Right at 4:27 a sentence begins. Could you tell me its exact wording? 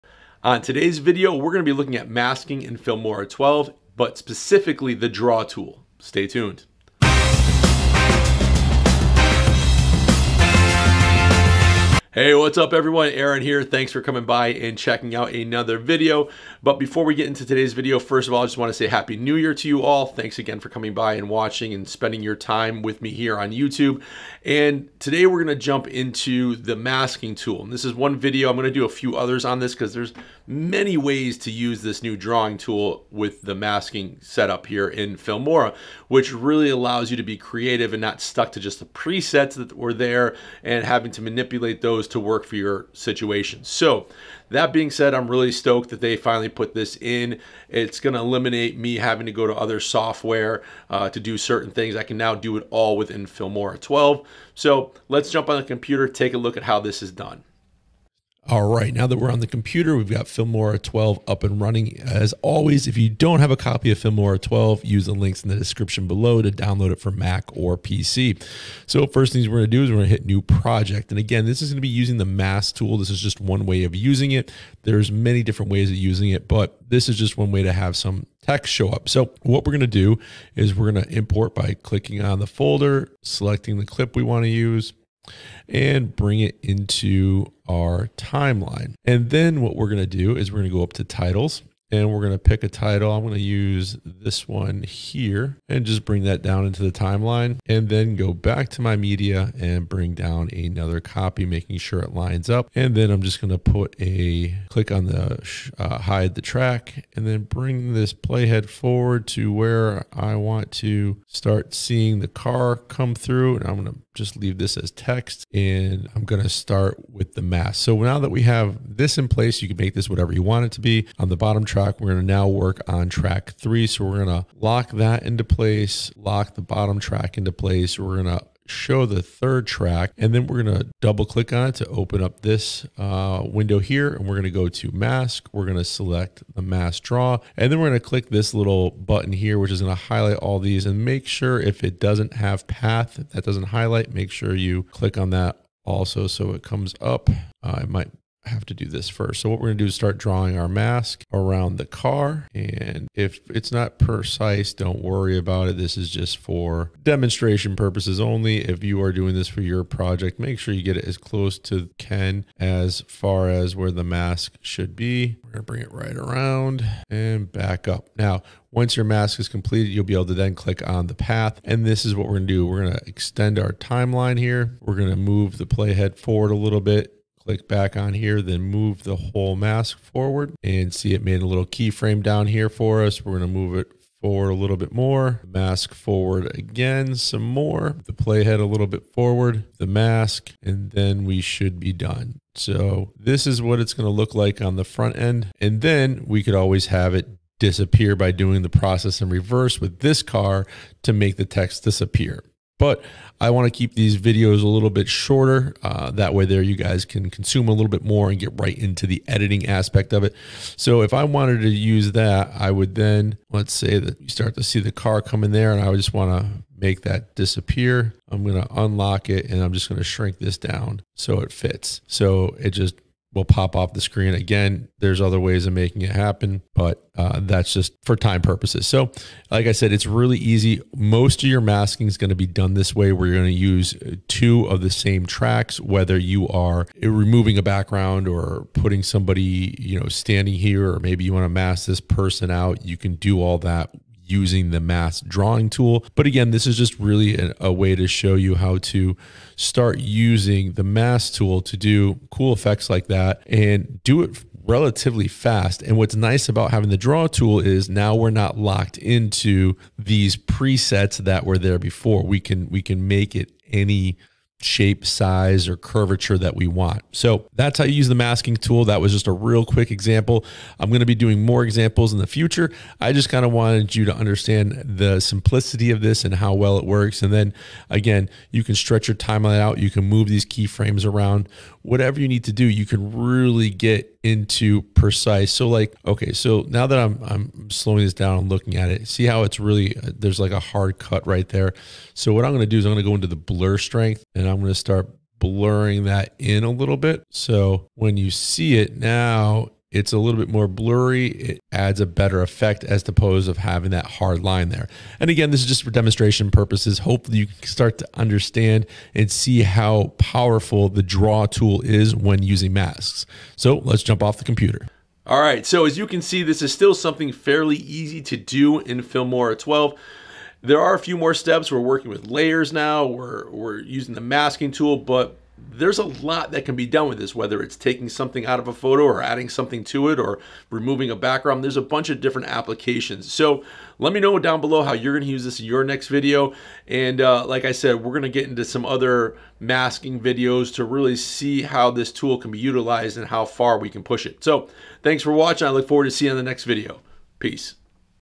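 So that's how you use the masking tool.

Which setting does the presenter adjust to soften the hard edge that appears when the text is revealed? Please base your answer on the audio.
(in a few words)
blur strength.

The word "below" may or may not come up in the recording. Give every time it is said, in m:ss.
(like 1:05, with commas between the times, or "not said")
1:06, 5:34.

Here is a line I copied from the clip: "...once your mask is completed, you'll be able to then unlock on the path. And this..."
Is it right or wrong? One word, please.
wrong.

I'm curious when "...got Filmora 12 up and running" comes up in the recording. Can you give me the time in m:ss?
1:00.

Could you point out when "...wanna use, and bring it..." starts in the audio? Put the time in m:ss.
1:24.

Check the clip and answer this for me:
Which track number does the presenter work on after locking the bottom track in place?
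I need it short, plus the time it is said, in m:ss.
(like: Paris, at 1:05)
3, at 2:03.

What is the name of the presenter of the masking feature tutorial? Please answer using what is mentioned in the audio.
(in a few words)
Aaron.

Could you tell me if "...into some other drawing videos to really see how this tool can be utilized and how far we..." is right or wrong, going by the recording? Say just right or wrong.
wrong.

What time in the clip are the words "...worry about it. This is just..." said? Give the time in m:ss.
2:35.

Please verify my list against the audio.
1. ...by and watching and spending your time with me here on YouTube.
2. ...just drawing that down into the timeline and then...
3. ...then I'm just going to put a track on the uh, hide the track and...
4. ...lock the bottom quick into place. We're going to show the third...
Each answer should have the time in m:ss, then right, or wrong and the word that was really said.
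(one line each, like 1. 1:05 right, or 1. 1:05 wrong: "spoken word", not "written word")
1. 0:20 right
2. 1:35 wrong: "bring", not "drawing"
3. 1:42 wrong: "click", not "track"
4. 2:06 wrong: "track", not "quick".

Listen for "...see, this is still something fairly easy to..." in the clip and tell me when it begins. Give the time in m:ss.
5:16.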